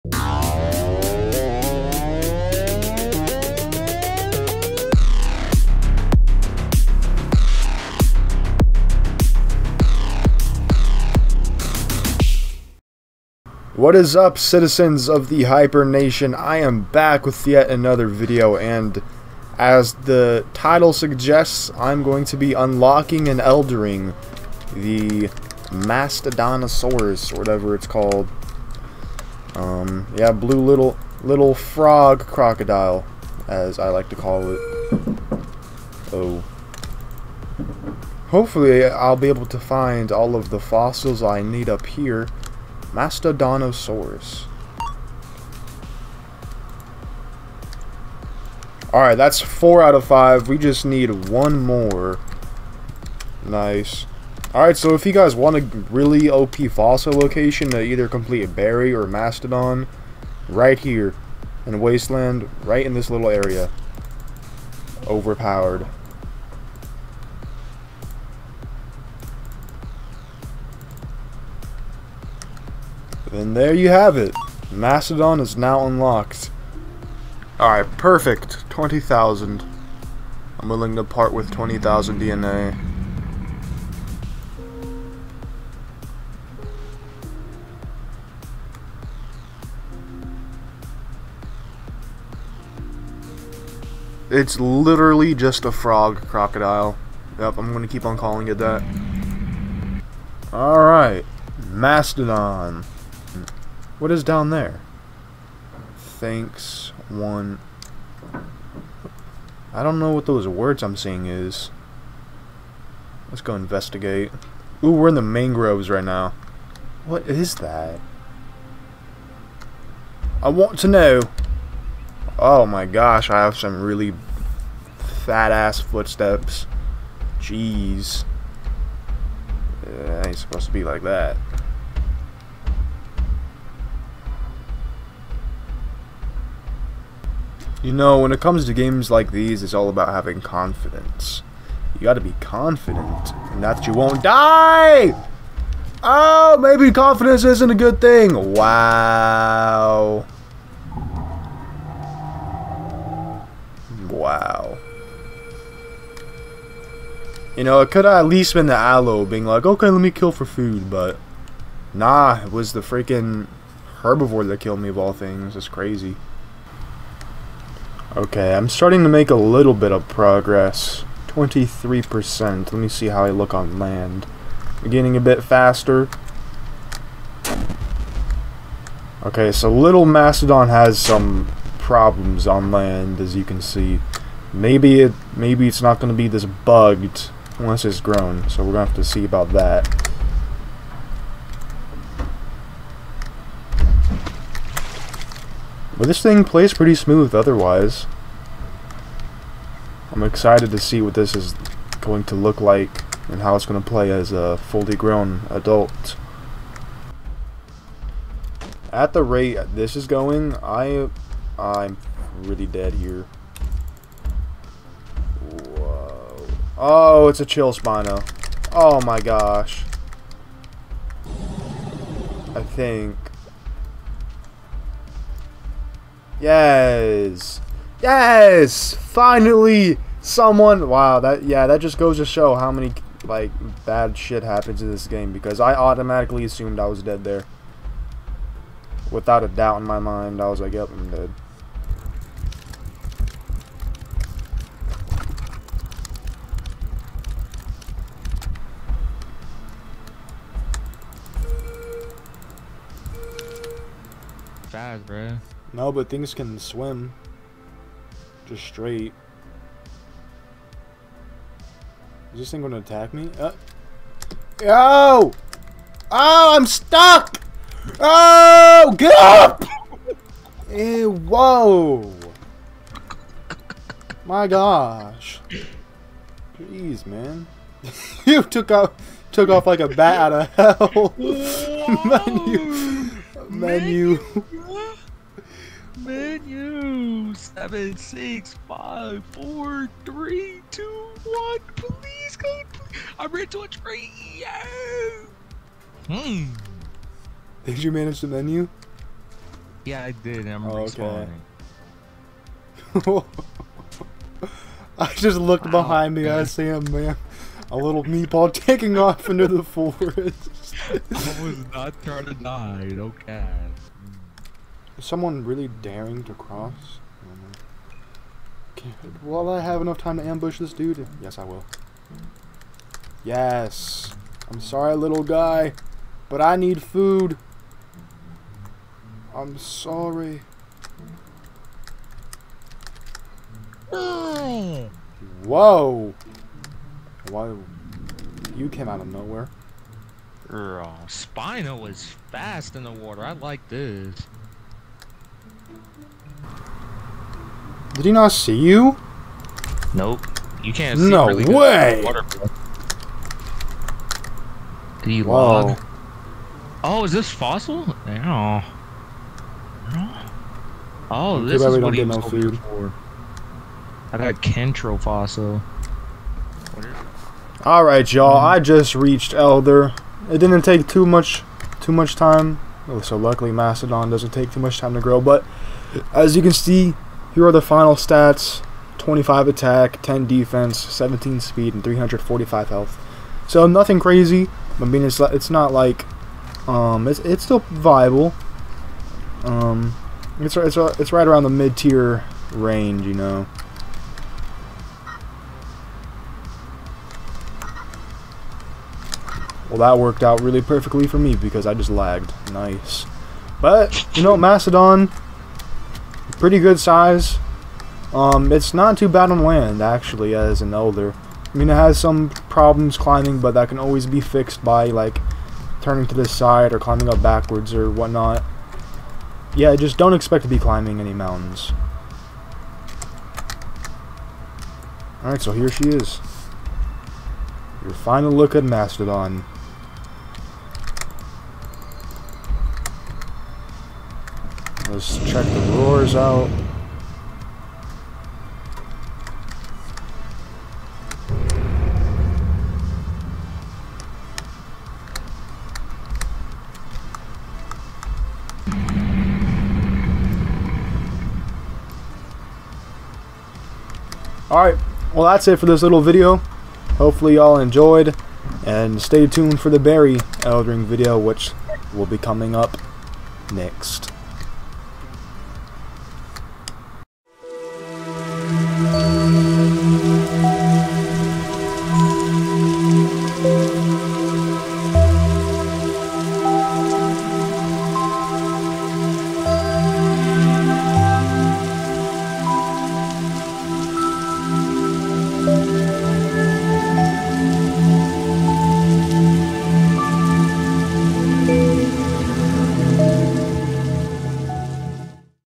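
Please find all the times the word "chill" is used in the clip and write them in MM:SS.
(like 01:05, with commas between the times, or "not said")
03:37.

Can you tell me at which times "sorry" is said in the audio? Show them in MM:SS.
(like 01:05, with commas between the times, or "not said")
05:24, 05:29.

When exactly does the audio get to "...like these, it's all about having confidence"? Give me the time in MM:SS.
02:19.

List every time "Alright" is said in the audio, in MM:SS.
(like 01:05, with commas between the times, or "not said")
00:48, 00:54, 01:17, 01:40, 06:07, 07:05, 07:34.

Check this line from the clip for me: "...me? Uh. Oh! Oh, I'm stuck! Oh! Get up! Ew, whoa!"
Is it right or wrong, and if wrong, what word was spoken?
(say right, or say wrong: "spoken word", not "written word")
right.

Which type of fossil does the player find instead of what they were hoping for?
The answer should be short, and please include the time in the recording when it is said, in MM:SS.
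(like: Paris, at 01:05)
Kentro, at 06:04.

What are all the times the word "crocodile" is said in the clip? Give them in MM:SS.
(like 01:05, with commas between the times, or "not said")
00:32, 01:36.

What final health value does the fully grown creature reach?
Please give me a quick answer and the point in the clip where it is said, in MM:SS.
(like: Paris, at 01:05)
345, at 06:21.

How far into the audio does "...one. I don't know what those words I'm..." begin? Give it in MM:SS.
01:47.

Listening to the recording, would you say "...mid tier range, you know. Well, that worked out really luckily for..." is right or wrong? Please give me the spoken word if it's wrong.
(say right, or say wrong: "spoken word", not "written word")
wrong: "perfectly", not "luckily".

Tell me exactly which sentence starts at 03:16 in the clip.
But this thing plays pretty smooth otherwise.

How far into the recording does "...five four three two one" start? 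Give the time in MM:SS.
04:48.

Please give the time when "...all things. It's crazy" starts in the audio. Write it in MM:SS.
02:44.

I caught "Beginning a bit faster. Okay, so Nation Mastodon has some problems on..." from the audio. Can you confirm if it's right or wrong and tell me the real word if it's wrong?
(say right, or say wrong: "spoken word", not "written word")
wrong: "Little", not "Nation".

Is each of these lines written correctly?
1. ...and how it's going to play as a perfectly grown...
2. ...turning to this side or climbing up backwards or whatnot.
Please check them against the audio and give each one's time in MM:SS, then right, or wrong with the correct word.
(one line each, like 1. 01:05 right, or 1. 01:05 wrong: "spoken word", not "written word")
1. 03:23 wrong: "fully", not "perfectly"
2. 06:55 right.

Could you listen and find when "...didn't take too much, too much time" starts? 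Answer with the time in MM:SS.
06:10.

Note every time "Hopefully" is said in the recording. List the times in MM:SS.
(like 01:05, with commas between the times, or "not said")
00:38, 07:36.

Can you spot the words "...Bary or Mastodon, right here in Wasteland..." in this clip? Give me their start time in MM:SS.
00:58.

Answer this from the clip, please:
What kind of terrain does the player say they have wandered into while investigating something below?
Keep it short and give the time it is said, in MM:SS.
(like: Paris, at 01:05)
mangroves, at 01:55.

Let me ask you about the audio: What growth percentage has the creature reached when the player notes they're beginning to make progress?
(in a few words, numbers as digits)
23%.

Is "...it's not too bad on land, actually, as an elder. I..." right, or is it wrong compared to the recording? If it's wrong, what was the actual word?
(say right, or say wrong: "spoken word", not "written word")
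right.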